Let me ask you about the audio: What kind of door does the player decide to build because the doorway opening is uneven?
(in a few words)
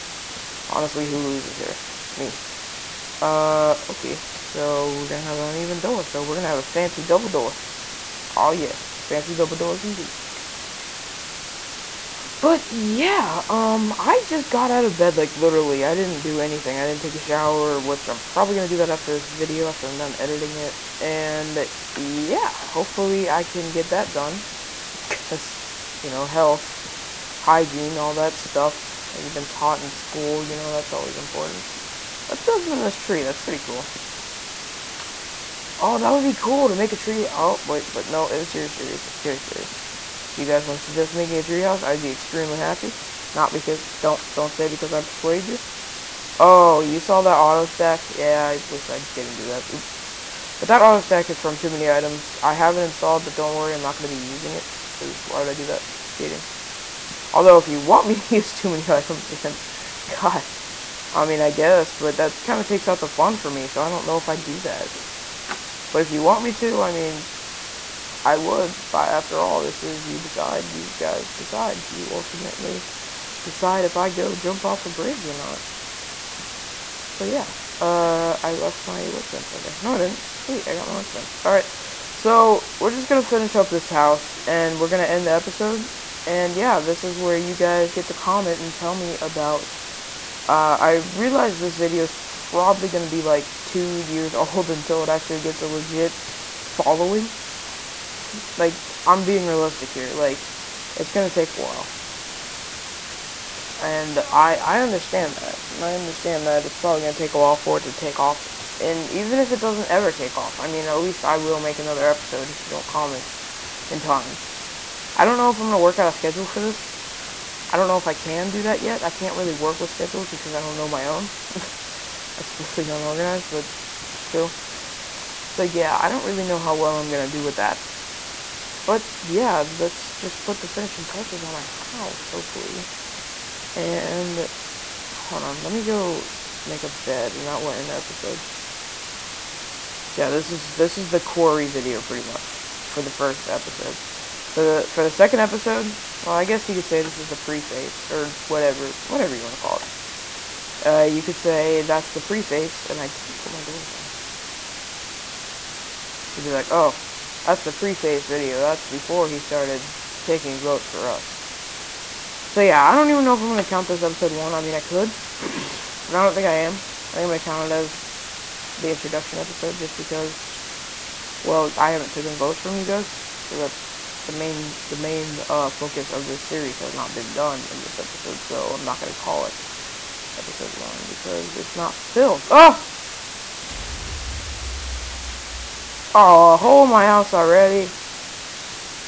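Fancy double door.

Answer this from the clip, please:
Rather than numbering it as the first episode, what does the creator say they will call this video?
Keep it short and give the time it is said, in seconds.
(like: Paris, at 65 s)
Introduction episode, at 168 s.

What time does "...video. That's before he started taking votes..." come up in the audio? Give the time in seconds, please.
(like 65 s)
158 s.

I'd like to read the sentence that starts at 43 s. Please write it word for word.
Not because, don't, don't say because I persuaded you.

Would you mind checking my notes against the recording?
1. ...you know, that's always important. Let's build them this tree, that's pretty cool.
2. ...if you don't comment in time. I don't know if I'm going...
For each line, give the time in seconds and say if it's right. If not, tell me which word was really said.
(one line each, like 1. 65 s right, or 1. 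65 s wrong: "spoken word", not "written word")
1. 30 s right
2. 112 s right.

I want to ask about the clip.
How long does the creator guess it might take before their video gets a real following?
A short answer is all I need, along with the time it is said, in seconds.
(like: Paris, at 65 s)
Two years, at 93 s.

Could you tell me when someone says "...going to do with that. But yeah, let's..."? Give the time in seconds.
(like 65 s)
127 s.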